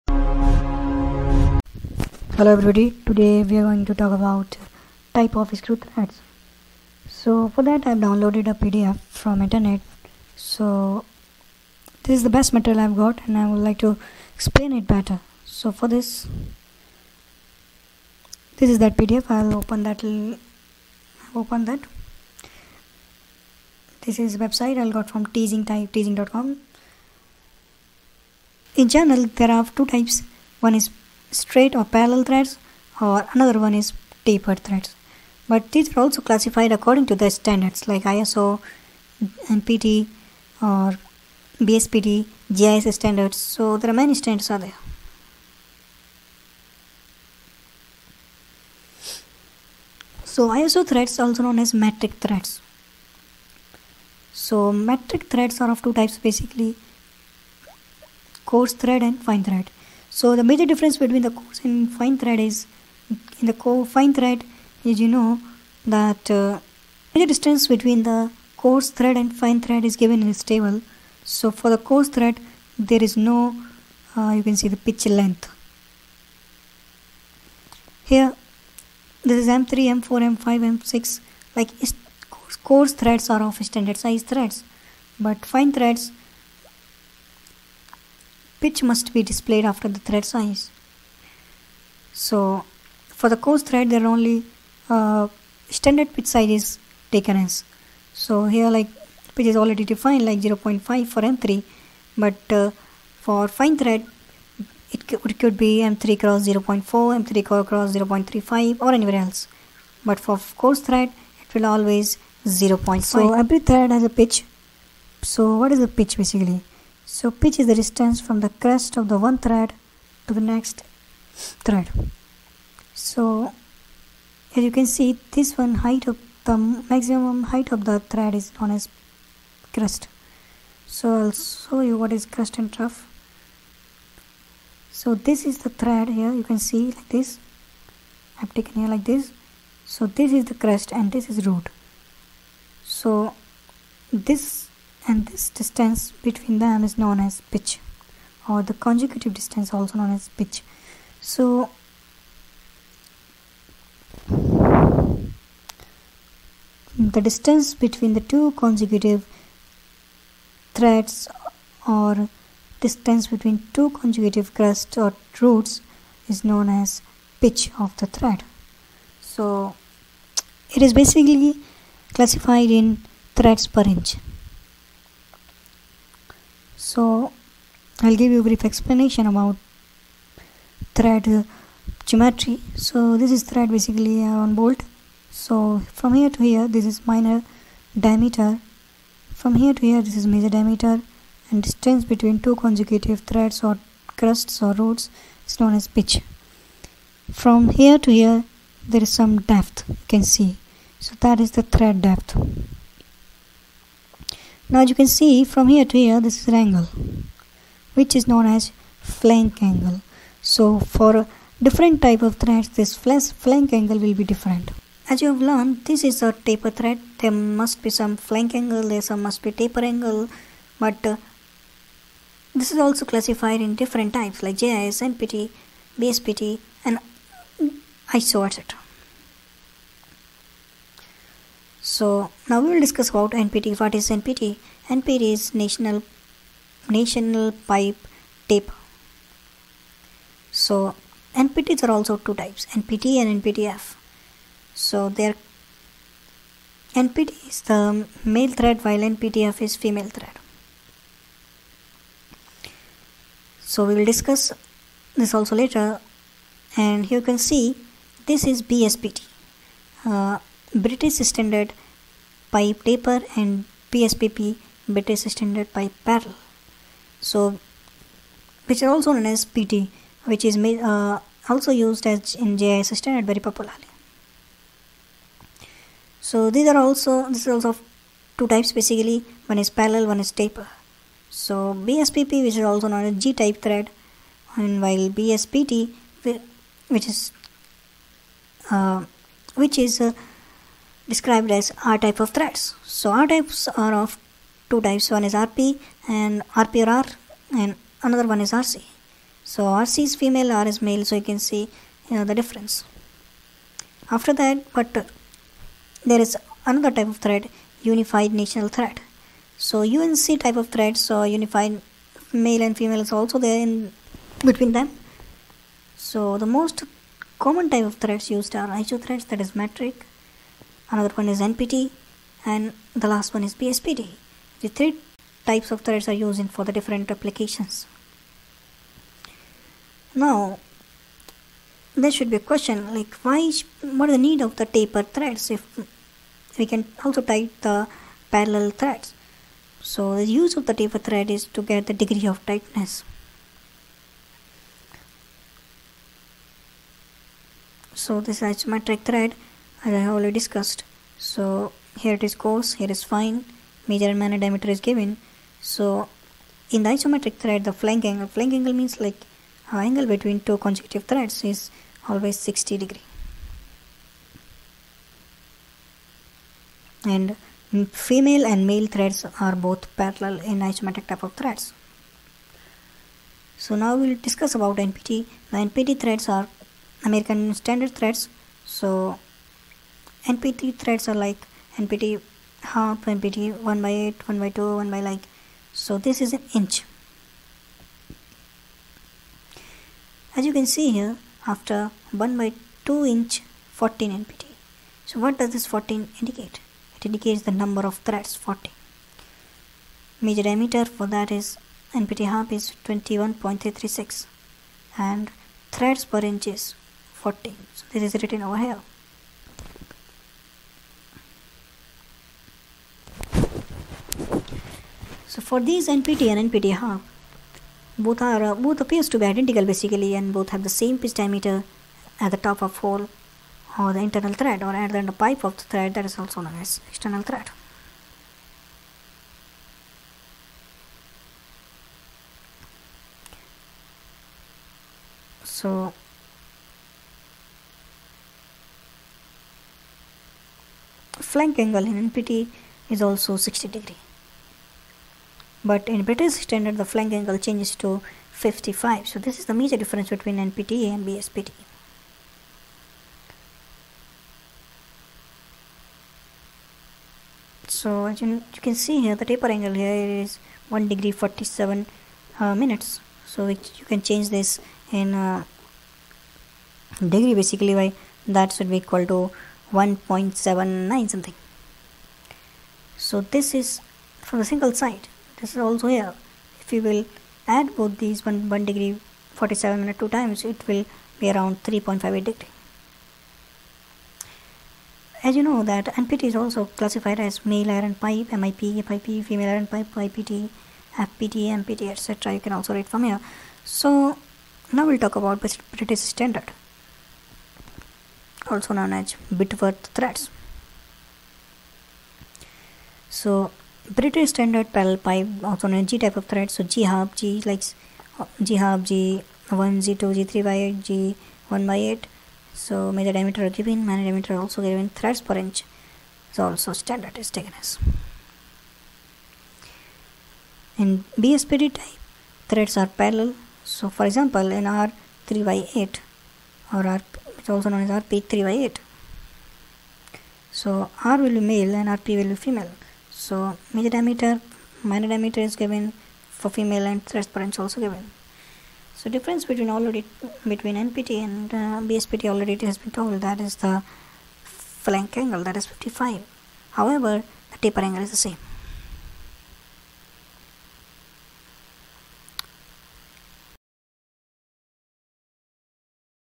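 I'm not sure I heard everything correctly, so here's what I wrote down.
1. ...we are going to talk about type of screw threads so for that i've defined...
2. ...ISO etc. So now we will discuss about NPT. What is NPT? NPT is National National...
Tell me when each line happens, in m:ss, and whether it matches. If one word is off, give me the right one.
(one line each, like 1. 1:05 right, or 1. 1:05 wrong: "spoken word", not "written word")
1. 0:03 wrong: "downloaded", not "defined"
2. 3:48 right.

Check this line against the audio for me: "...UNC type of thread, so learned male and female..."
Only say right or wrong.
wrong.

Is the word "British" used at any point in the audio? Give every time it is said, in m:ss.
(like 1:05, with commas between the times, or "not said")
4:20, 4:24, 7:26, 8:15, 8:23.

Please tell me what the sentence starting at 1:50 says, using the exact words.
But for coarse thread it will always 0.5.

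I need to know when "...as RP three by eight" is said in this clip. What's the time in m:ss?
8:47.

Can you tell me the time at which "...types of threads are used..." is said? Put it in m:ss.
5:25.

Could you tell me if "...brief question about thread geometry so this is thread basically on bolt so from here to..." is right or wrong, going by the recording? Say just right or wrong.
wrong.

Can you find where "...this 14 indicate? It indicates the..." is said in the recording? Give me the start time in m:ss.
6:35.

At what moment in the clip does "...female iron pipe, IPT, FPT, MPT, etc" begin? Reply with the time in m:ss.
8:09.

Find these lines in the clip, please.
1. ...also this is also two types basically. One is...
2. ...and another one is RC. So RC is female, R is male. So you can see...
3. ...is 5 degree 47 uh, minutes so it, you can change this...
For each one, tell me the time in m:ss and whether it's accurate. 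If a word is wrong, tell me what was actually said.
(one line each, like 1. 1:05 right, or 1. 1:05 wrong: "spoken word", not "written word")
1. 4:36 right
2. 4:57 right
3. 7:40 wrong: "1", not "5".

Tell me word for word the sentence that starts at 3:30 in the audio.
So for different type of threads this flank angle will be different.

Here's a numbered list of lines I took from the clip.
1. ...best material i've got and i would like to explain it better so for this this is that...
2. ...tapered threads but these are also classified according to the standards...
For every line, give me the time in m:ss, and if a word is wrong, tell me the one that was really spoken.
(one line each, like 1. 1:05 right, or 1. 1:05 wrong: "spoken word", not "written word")
1. 0:12 right
2. 0:34 right.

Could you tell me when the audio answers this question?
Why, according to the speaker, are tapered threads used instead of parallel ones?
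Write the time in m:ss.
5:41.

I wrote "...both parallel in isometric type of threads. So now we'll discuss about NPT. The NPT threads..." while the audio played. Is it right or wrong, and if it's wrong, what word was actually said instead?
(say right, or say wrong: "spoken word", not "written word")
right.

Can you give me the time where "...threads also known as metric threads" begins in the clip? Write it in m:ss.
0:50.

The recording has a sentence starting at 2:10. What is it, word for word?
So I'll show you what is crest and trough.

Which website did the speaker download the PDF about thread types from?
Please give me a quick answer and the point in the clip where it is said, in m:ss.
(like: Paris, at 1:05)
teasing.com, at 0:25.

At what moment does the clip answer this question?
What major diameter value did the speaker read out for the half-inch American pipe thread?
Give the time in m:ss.
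6:42.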